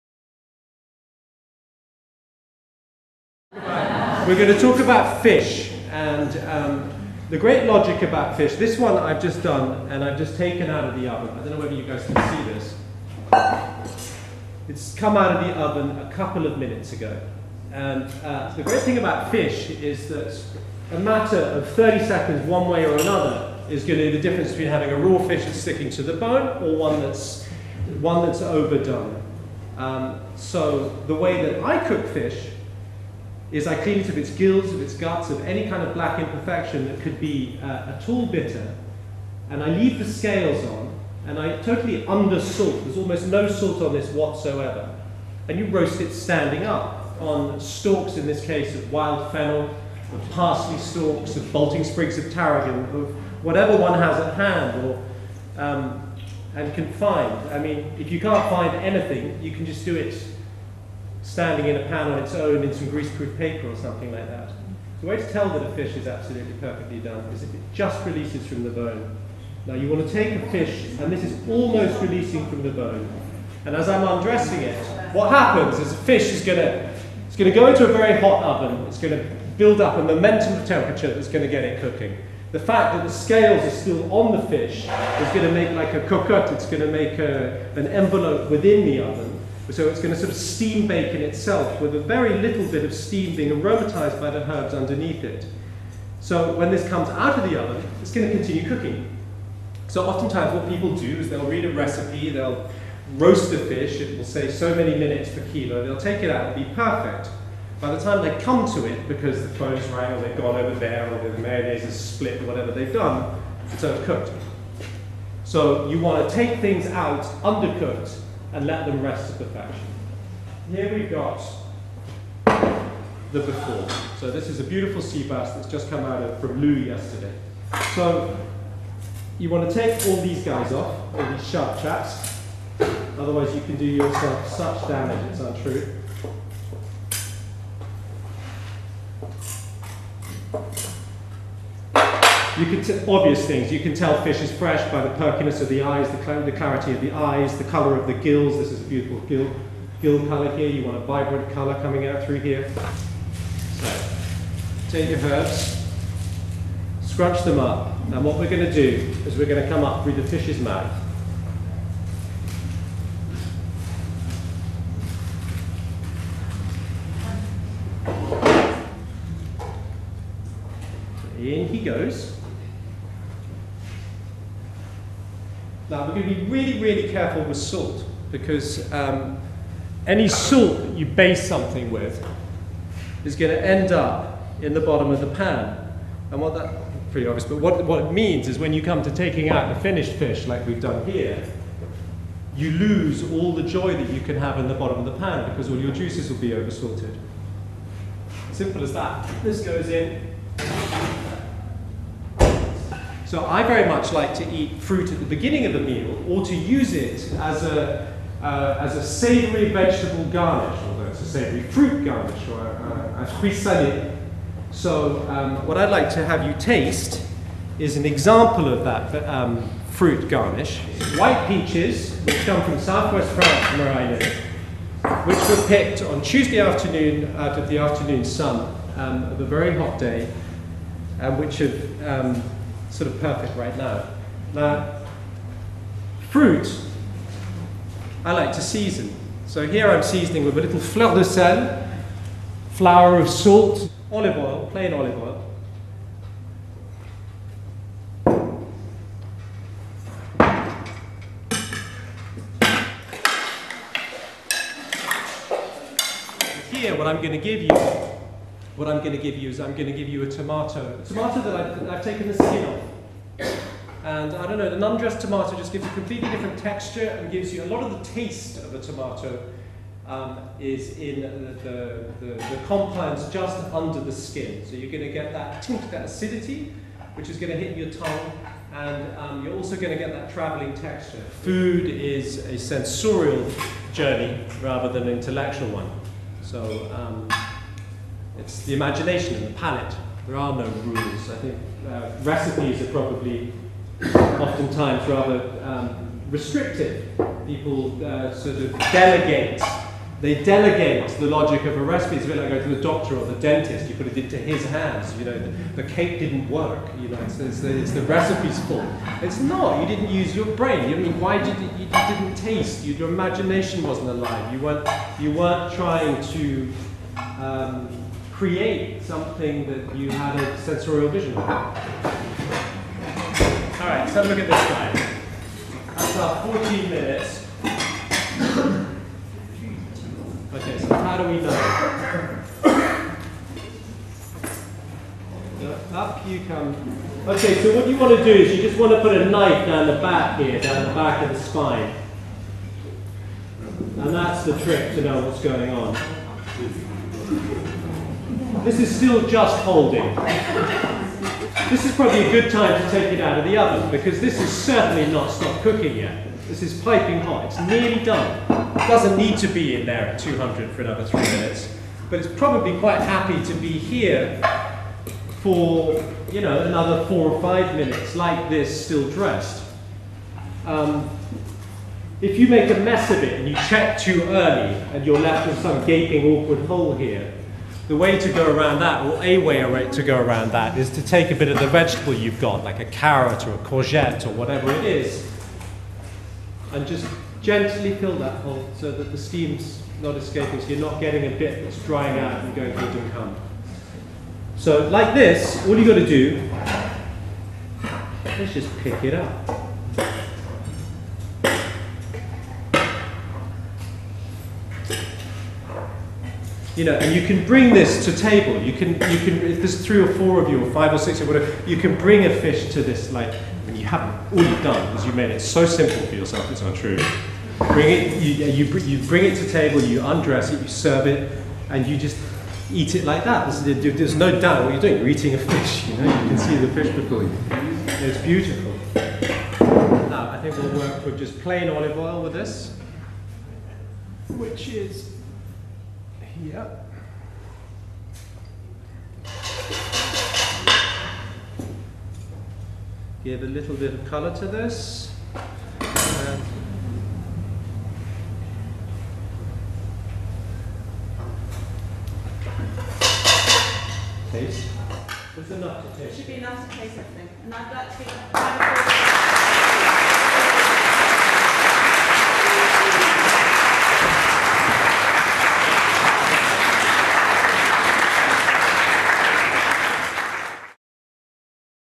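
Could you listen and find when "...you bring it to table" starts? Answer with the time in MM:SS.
06:58.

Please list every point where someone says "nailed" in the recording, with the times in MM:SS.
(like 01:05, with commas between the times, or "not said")
not said.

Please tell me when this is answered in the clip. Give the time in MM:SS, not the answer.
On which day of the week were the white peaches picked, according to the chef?
03:46.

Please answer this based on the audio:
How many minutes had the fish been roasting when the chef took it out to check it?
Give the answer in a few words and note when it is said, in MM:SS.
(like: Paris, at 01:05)
14, at 05:26.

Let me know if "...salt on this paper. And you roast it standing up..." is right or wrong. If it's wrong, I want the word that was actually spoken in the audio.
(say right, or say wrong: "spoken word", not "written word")
wrong: "whatsoever", not "paper".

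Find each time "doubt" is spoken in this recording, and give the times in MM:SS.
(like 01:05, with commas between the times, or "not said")
07:04.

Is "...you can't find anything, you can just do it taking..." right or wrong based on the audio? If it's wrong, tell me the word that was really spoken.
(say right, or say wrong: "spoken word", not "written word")
wrong: "standing", not "taking".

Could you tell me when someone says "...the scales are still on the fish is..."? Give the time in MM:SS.
01:23.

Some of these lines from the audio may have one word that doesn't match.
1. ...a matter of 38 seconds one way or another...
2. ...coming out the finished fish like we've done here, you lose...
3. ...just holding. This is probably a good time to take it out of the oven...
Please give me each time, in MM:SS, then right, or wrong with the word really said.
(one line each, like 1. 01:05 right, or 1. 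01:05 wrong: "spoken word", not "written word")
1. 00:20 wrong: "30", not "38"
2. 03:09 wrong: "taking", not "coming"
3. 05:49 right.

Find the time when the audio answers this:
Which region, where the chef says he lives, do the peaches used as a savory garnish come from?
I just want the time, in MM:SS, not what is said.
03:42.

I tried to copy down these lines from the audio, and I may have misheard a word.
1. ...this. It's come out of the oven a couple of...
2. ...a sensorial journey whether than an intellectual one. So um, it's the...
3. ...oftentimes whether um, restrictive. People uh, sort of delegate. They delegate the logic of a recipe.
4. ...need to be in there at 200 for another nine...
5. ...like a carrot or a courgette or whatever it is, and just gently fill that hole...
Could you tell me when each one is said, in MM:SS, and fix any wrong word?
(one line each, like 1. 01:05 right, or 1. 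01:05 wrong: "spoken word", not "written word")
1. 00:12 right
2. 04:42 wrong: "rather", not "whether"
3. 04:54 wrong: "rather", not "whether"
4. 05:59 wrong: "three", not "nine"
5. 06:22 right.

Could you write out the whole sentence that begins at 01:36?
So when this comes out of the oven, it's going to continue cooking.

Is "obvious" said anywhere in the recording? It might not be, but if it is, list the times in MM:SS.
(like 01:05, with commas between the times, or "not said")
02:23, 03:07.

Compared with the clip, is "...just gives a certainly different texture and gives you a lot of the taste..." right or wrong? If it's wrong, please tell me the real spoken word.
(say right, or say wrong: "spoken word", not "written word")
wrong: "completely", not "certainly".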